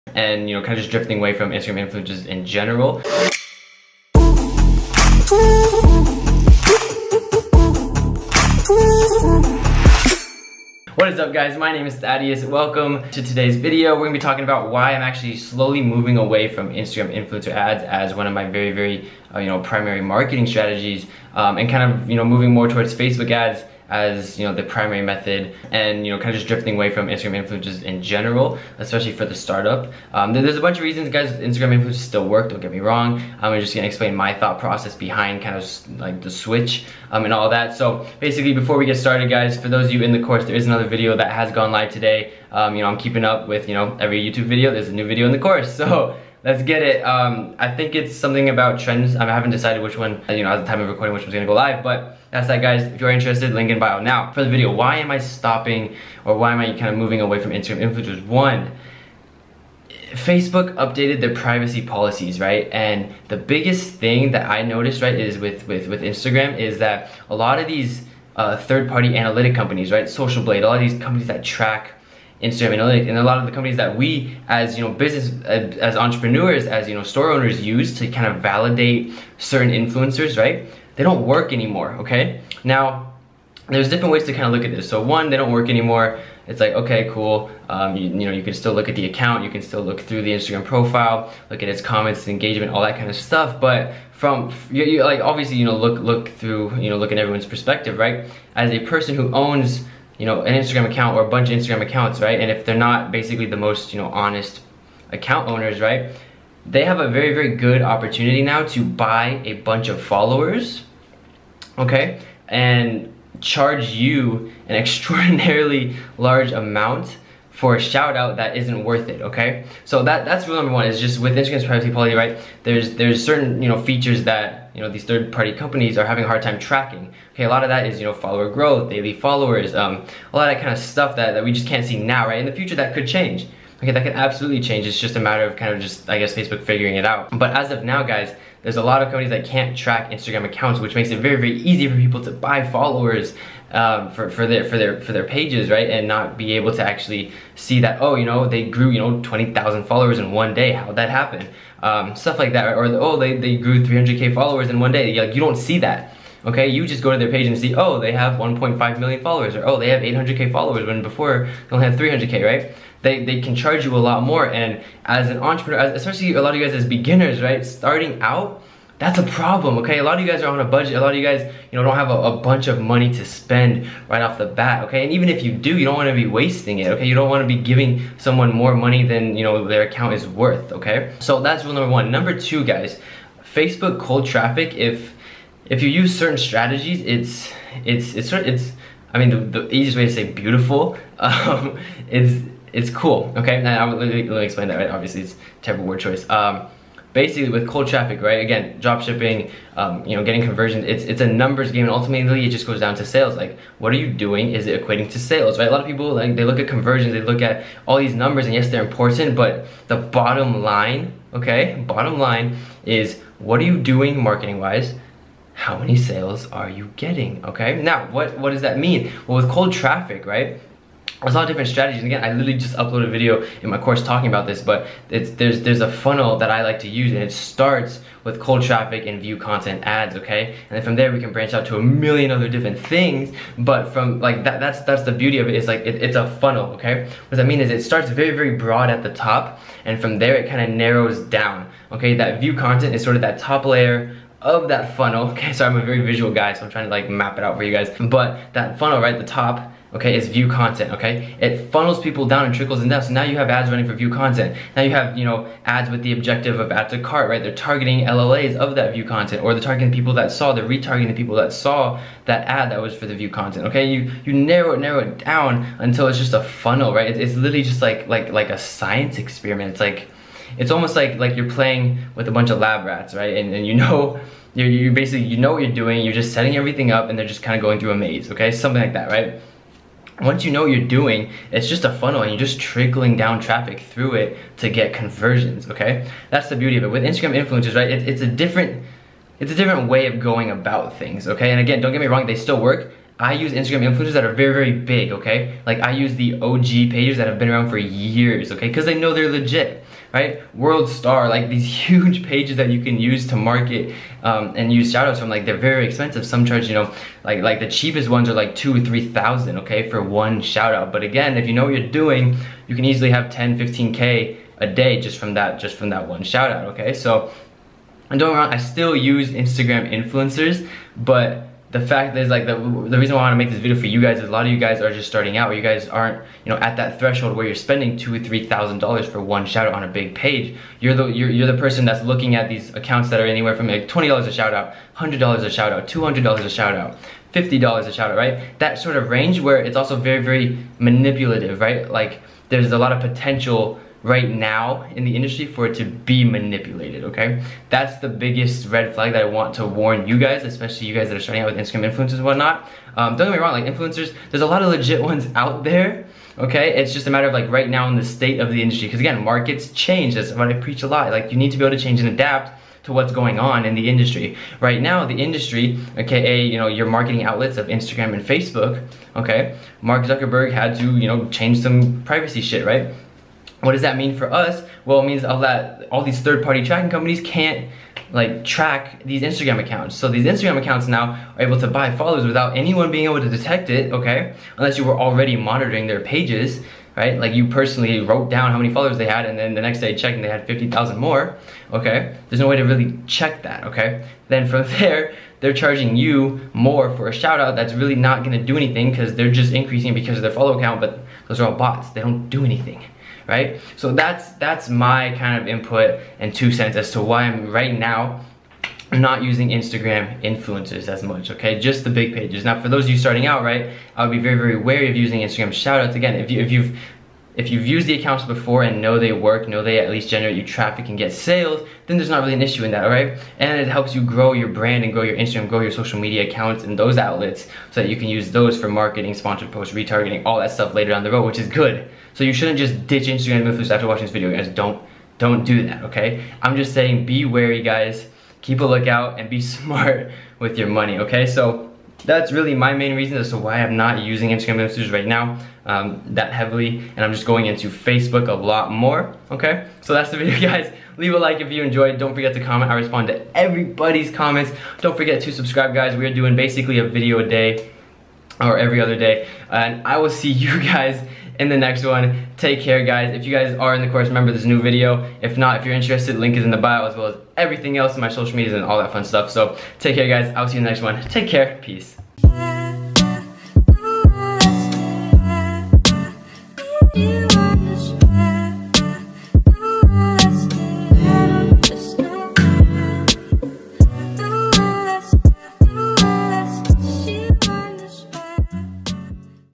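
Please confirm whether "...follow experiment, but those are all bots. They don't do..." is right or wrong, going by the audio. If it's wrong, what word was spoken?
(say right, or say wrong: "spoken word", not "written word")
wrong: "account", not "experiment".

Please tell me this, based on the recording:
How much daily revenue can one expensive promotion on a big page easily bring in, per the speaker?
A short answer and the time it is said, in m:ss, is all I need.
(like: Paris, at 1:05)
10, 15K, at 5:13.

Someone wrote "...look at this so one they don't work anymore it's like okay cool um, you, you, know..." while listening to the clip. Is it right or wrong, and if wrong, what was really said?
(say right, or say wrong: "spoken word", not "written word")
right.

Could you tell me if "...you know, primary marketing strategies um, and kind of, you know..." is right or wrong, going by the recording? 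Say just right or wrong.
right.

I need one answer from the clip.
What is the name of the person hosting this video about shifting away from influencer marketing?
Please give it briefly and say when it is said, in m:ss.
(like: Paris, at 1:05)
Thaddeus, at 0:11.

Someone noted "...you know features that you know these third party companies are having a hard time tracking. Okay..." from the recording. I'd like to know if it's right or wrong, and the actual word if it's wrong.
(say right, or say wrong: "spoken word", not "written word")
right.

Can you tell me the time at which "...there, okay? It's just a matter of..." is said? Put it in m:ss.
5:55.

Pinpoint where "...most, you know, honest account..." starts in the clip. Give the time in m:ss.
1:43.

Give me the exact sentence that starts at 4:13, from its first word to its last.
So now you have ads running for view content.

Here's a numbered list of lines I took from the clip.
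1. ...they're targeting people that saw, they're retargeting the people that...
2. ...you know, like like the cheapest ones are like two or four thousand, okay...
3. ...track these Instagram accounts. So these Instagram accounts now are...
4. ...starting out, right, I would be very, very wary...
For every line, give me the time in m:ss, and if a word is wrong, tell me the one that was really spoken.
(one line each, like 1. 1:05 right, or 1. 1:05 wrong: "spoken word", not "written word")
1. 4:19 right
2. 5:06 wrong: "three", not "four"
3. 6:18 right
4. 6:52 right.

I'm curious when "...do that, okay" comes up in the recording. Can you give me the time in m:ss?
7:15.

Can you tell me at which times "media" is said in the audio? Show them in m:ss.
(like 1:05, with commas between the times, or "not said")
7:05, 7:48.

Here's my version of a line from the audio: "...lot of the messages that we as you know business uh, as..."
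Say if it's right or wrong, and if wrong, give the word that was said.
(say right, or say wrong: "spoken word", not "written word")
wrong: "companies", not "messages".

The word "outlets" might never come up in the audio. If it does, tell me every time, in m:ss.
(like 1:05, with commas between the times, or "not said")
6:07, 7:06.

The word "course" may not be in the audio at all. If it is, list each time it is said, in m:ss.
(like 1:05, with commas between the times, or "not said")
0:40, 0:45, 3:43, 7:43.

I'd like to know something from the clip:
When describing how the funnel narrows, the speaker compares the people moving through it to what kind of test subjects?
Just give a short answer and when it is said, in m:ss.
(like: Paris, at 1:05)
Lab rats, at 4:32.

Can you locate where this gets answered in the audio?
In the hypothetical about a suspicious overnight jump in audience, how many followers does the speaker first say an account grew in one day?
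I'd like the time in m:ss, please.
2:29.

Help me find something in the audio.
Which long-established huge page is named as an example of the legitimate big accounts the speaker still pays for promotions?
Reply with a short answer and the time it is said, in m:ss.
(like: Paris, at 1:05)
World Star, at 5:00.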